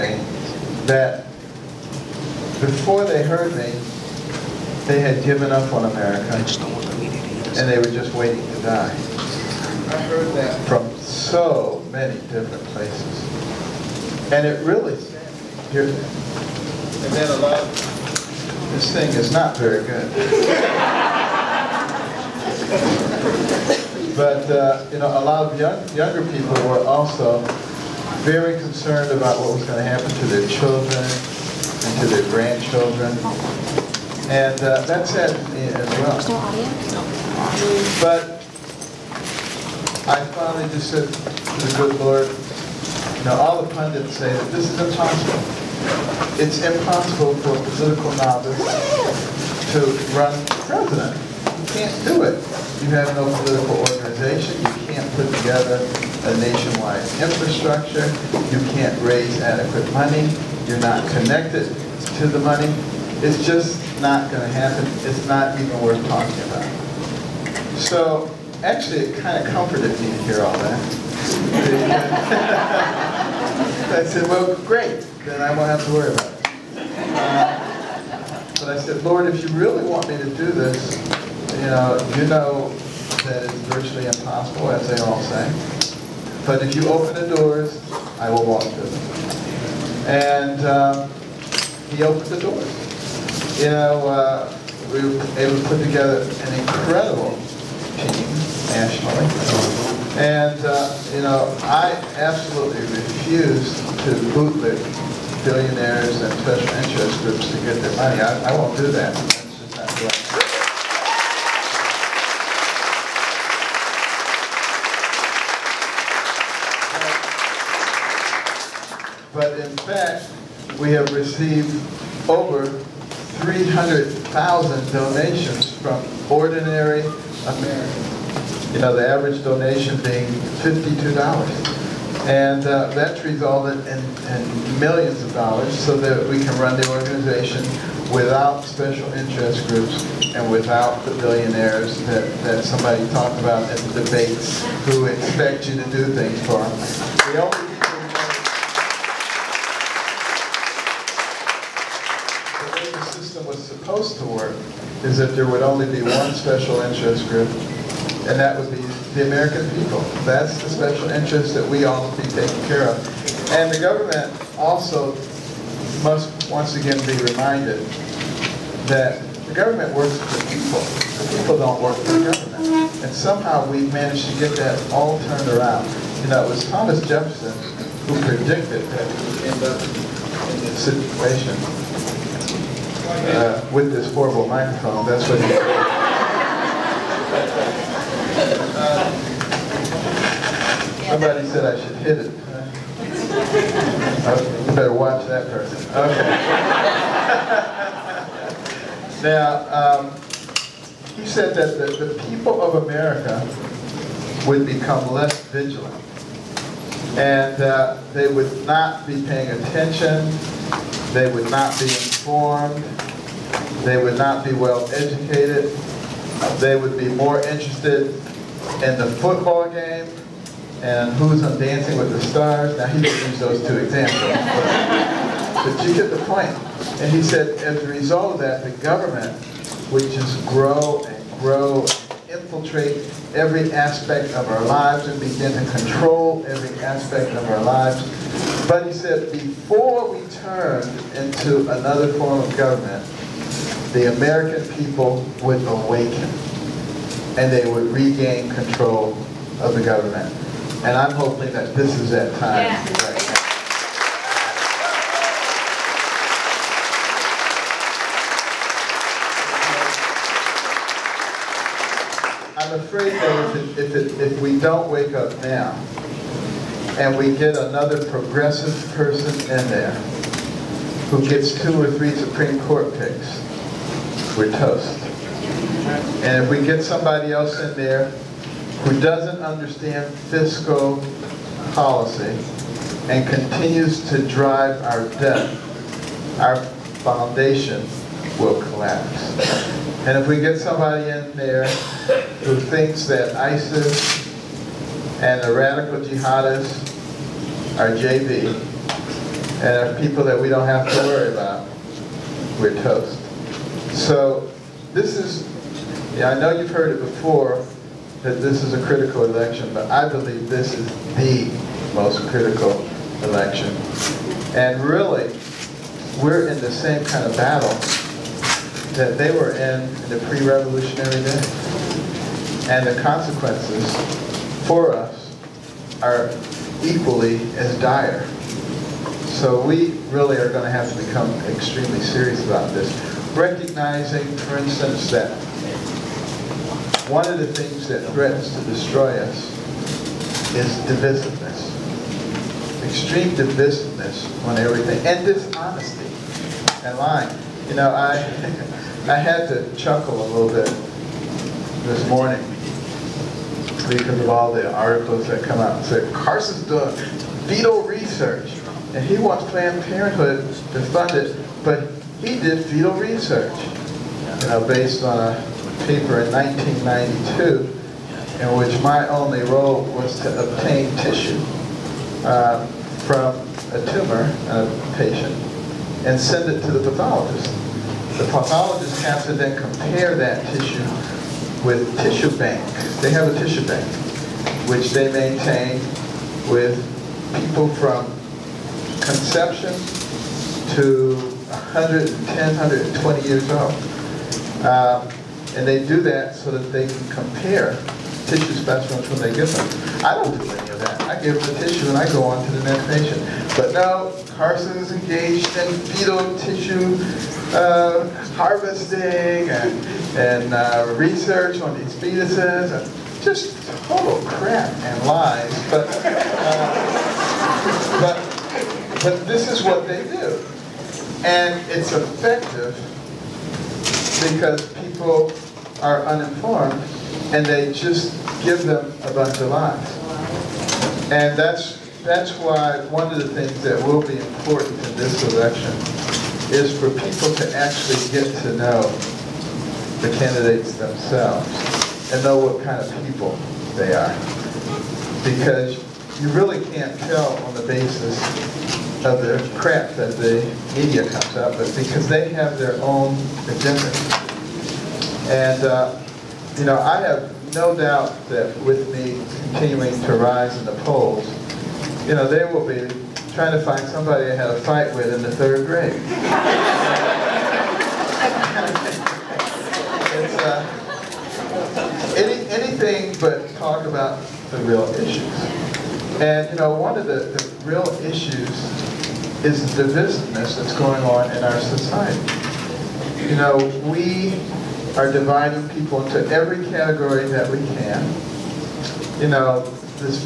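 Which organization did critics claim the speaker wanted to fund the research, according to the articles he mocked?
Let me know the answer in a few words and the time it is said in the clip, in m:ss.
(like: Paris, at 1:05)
Planned Parenthood, at 5:59.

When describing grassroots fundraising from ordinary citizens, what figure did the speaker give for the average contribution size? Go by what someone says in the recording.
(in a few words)
$52.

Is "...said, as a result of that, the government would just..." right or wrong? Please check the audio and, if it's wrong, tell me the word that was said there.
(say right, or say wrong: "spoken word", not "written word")
right.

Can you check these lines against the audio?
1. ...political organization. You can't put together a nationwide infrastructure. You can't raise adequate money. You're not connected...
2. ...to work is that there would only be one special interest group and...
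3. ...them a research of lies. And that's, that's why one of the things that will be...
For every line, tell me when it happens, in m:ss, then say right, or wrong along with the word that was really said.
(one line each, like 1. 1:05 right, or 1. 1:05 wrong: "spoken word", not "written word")
1. 0:53 right
2. 2:34 right
3. 7:08 wrong: "bunch", not "research".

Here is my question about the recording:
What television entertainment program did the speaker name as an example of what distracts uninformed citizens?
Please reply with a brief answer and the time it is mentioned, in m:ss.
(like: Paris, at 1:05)
Dancing with the Stars, at 3:41.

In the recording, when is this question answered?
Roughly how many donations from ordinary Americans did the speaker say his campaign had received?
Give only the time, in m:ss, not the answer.
2:03.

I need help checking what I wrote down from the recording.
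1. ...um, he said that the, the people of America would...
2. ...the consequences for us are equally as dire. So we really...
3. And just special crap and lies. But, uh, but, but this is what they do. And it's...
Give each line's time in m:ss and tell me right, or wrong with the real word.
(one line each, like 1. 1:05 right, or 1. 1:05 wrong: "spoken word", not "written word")
1. 3:19 right
2. 5:22 right
3. 6:52 wrong: "total", not "special".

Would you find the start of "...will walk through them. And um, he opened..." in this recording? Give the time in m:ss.
1:28.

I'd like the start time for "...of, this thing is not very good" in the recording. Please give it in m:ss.
0:17.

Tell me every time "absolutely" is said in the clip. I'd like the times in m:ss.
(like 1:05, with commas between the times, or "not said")
1:42.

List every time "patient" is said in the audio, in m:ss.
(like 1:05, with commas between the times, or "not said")
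6:14, 6:42.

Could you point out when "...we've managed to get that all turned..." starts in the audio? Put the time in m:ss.
2:53.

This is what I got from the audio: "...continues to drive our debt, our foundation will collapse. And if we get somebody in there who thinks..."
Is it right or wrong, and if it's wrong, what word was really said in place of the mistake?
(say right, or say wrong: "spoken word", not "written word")
right.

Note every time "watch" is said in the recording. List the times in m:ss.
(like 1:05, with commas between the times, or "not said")
3:14.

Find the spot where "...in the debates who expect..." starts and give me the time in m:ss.
2:23.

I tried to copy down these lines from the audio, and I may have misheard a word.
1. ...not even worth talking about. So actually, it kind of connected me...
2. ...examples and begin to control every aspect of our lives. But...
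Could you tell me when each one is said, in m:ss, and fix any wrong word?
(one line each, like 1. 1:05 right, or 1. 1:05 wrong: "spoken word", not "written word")
1. 1:05 wrong: "comforted", not "connected"
2. 3:54 wrong: "lives", not "examples".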